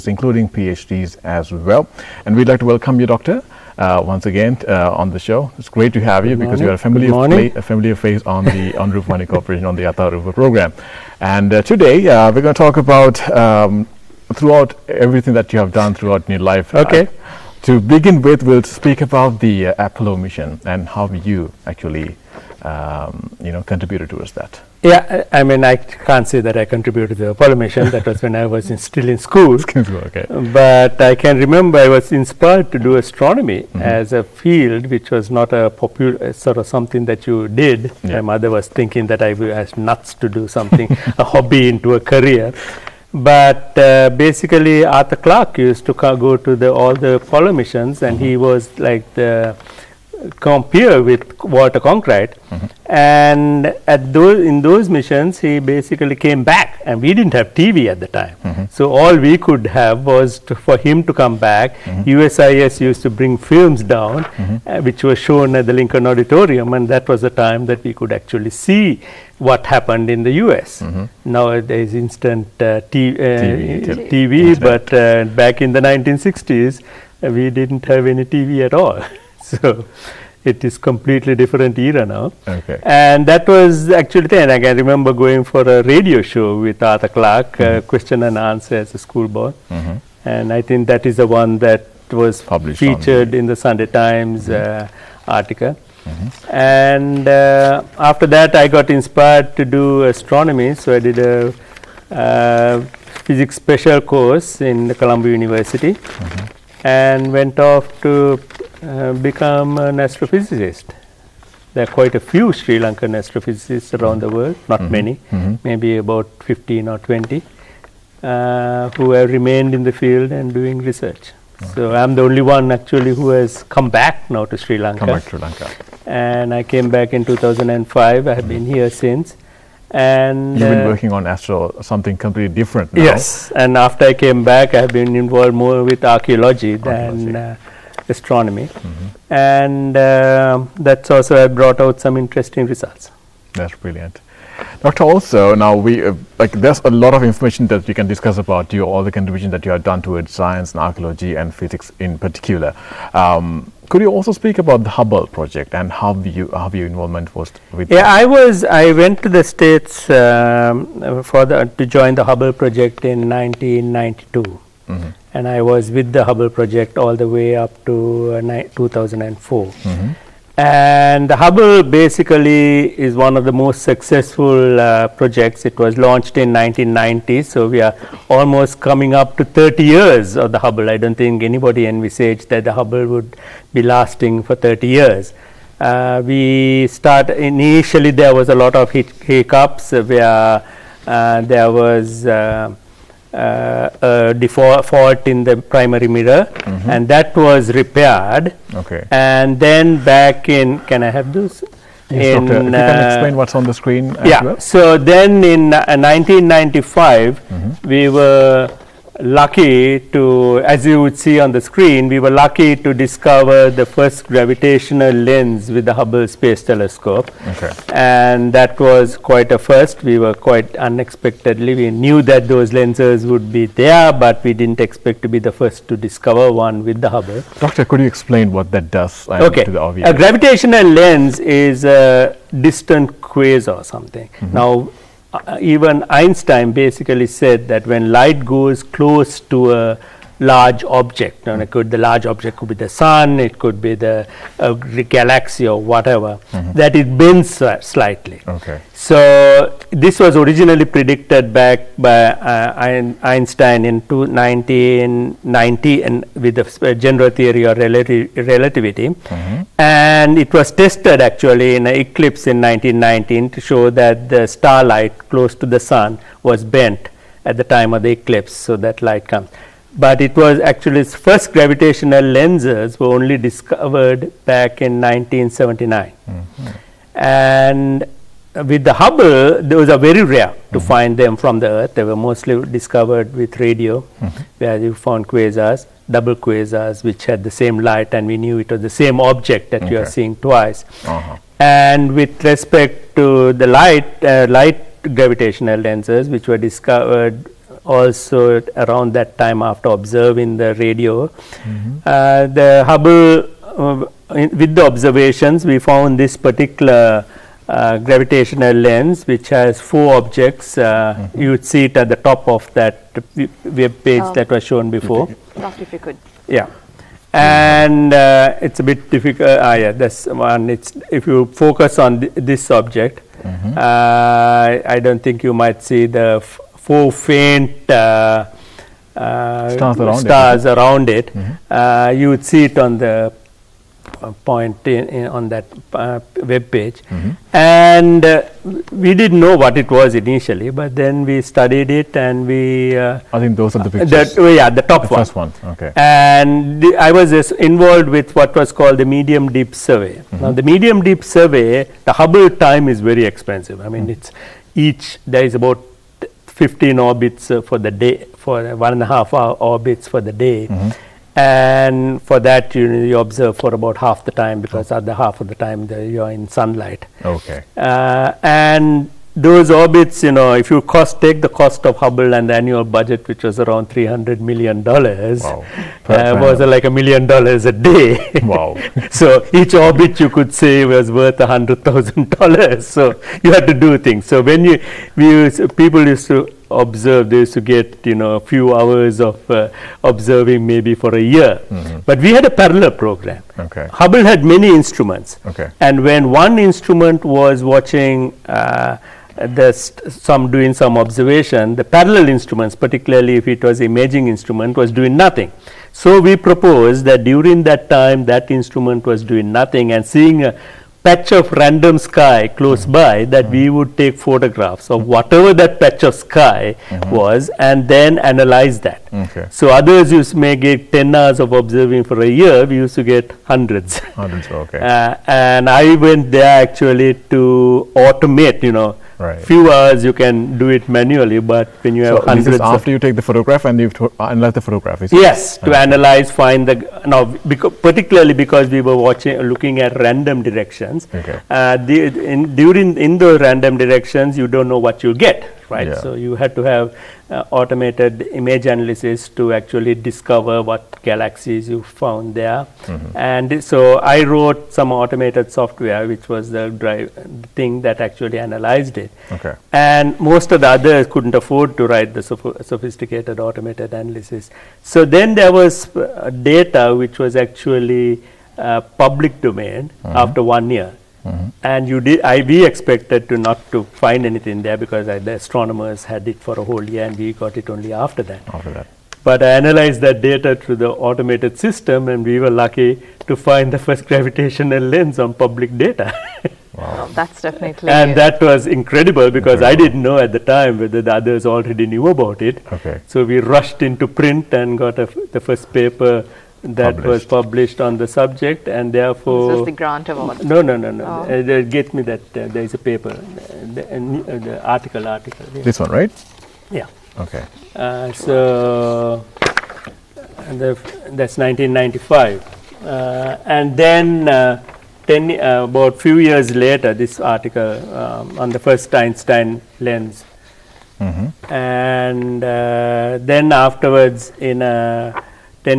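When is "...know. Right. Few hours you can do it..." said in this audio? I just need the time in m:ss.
7:08.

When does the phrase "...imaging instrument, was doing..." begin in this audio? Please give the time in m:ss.
6:43.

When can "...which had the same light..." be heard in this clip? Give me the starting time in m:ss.
4:47.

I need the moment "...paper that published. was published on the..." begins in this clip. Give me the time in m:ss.
8:15.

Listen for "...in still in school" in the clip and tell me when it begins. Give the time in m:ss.
0:28.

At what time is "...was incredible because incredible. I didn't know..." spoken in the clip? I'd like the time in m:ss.
8:08.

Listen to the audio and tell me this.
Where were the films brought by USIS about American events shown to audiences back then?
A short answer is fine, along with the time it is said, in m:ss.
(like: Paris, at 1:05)
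Lincoln Auditorium, at 1:05.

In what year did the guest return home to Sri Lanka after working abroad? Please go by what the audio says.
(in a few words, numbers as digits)
2005.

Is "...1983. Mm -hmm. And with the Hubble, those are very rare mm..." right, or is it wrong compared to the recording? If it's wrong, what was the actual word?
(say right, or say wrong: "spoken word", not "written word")
wrong: "1979", not "1983".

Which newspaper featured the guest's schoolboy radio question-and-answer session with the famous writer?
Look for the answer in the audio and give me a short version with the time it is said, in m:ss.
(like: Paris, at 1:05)
Sunday Times, at 1:33.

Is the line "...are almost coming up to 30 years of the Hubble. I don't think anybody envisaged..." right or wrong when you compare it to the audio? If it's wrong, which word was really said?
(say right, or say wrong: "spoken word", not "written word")
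right.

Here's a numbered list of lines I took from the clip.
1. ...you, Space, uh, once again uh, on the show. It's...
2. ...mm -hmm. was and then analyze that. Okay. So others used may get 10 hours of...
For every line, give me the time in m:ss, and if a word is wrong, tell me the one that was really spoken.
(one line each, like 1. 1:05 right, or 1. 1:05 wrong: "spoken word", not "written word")
1. 0:03 wrong: "Doctor", not "Space"
2. 6:56 right.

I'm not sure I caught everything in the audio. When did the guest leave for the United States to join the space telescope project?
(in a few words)
1992.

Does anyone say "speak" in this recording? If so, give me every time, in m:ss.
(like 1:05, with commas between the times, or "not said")
0:18, 2:34.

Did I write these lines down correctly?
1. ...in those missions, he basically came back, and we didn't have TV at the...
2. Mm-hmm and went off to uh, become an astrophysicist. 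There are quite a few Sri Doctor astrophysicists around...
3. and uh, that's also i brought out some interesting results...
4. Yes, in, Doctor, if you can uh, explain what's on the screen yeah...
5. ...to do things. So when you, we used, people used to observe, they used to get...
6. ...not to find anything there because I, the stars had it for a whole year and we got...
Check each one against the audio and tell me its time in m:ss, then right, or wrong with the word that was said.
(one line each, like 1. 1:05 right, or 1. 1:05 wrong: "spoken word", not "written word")
1. 0:54 right
2. 1:45 wrong: "Lankan", not "Doctor"
3. 2:19 right
4. 3:22 right
5. 6:23 right
6. 7:53 wrong: "astronomers", not "stars".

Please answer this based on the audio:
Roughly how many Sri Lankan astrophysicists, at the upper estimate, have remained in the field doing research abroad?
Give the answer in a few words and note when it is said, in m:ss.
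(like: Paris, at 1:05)
20, at 1:57.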